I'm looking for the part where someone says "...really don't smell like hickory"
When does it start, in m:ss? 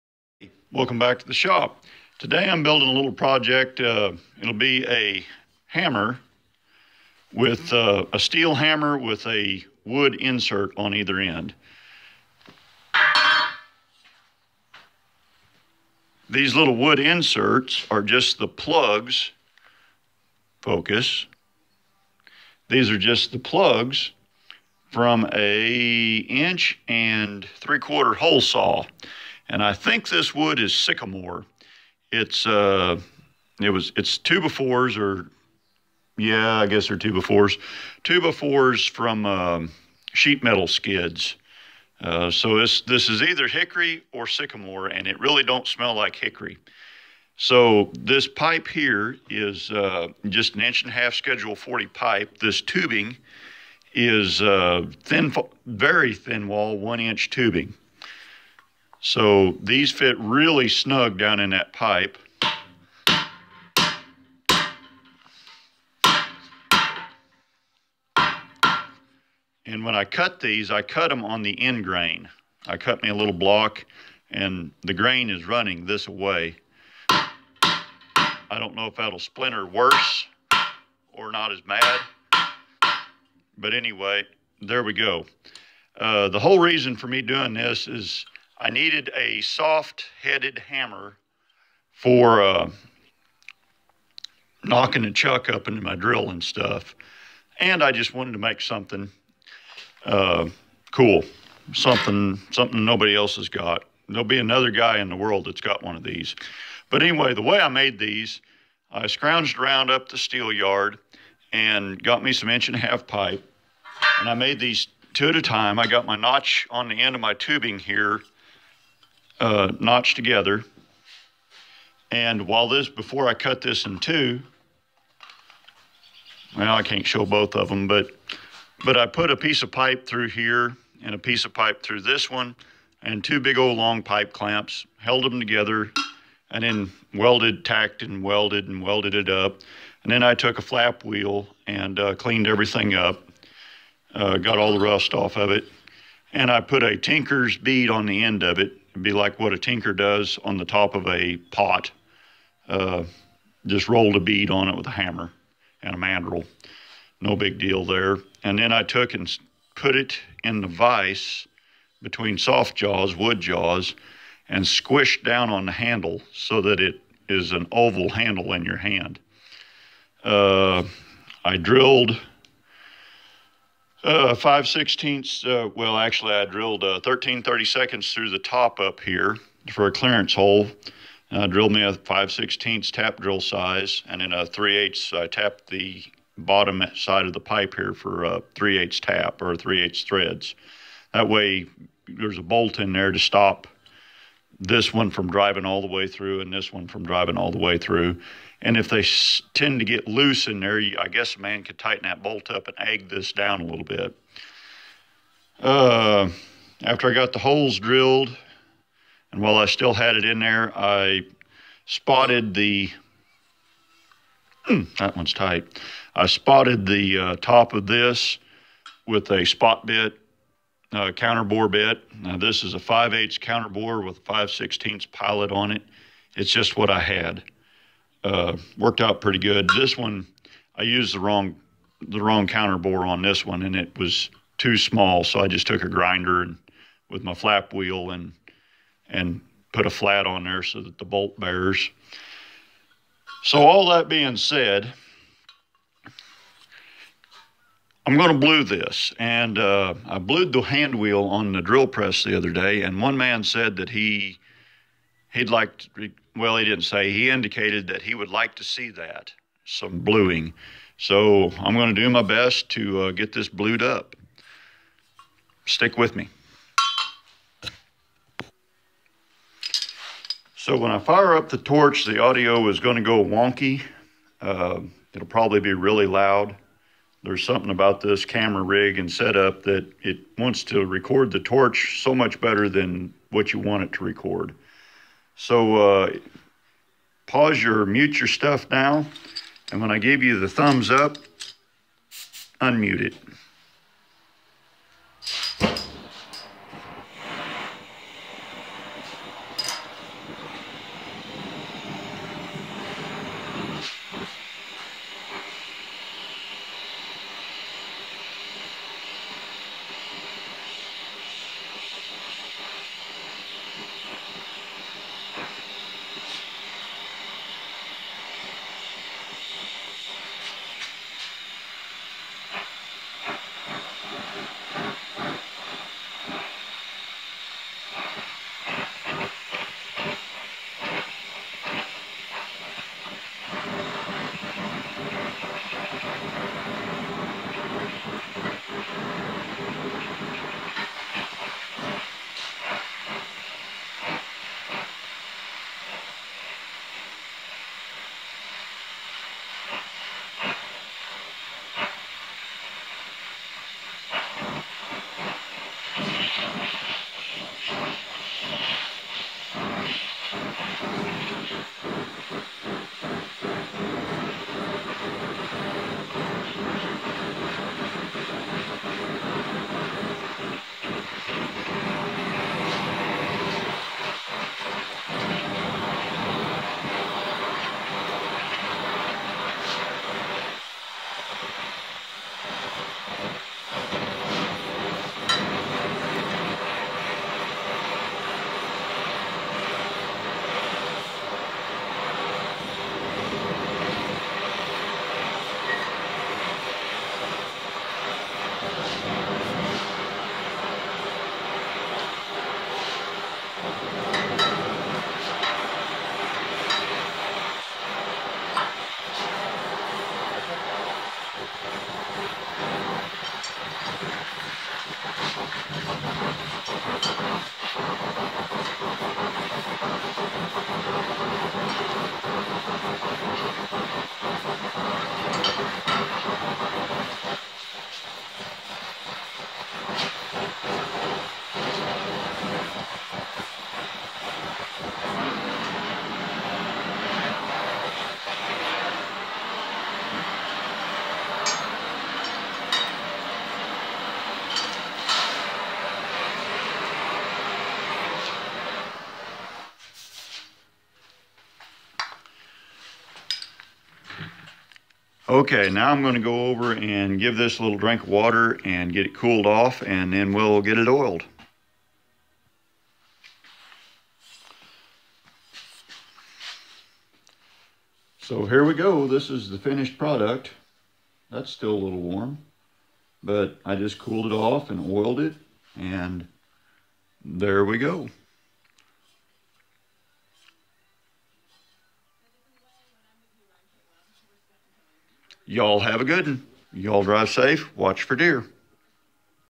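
0:45.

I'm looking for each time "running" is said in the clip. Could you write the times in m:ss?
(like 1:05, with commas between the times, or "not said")
1:15.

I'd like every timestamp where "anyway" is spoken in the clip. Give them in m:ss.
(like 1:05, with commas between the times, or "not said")
1:23, 1:47.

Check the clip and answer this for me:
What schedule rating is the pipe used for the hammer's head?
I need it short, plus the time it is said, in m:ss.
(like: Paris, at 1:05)
Schedule 40, at 0:51.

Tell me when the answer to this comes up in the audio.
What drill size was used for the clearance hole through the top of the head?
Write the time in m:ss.
2:57.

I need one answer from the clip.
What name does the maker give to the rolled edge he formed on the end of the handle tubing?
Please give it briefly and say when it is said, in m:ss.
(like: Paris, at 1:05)
tinker's bead, at 2:26.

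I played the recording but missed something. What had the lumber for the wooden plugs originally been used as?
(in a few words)
sheet metal skids.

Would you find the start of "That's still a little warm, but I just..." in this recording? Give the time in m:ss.
7:51.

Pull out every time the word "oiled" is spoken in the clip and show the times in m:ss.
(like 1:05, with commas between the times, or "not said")
7:40, 7:54.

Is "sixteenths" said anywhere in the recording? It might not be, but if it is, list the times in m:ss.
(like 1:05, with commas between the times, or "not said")
2:54, 3:02.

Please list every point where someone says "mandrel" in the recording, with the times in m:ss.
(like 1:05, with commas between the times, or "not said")
2:35.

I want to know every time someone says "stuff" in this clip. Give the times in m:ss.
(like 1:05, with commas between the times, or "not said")
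1:36, 4:48.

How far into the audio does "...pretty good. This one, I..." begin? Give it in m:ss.
3:49.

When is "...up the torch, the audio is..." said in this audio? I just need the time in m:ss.
4:31.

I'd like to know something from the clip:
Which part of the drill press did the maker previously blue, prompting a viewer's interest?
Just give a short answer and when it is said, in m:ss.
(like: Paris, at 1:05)
hand wheel, at 4:10.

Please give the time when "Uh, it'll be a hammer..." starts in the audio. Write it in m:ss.
0:03.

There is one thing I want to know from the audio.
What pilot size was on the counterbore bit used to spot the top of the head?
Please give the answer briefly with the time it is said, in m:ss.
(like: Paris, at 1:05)
5/16, at 3:44.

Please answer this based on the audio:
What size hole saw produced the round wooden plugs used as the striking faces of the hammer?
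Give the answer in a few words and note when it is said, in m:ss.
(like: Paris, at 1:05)
1 3/4 inch, at 0:26.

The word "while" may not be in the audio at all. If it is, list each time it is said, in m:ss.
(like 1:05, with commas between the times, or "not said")
2:02, 3:29.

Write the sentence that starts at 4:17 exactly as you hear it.
He indicated that he would like to see that, some bluing.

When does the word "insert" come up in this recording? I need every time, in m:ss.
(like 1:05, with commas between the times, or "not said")
0:10, 0:16.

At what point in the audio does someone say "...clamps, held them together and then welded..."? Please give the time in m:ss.
2:14.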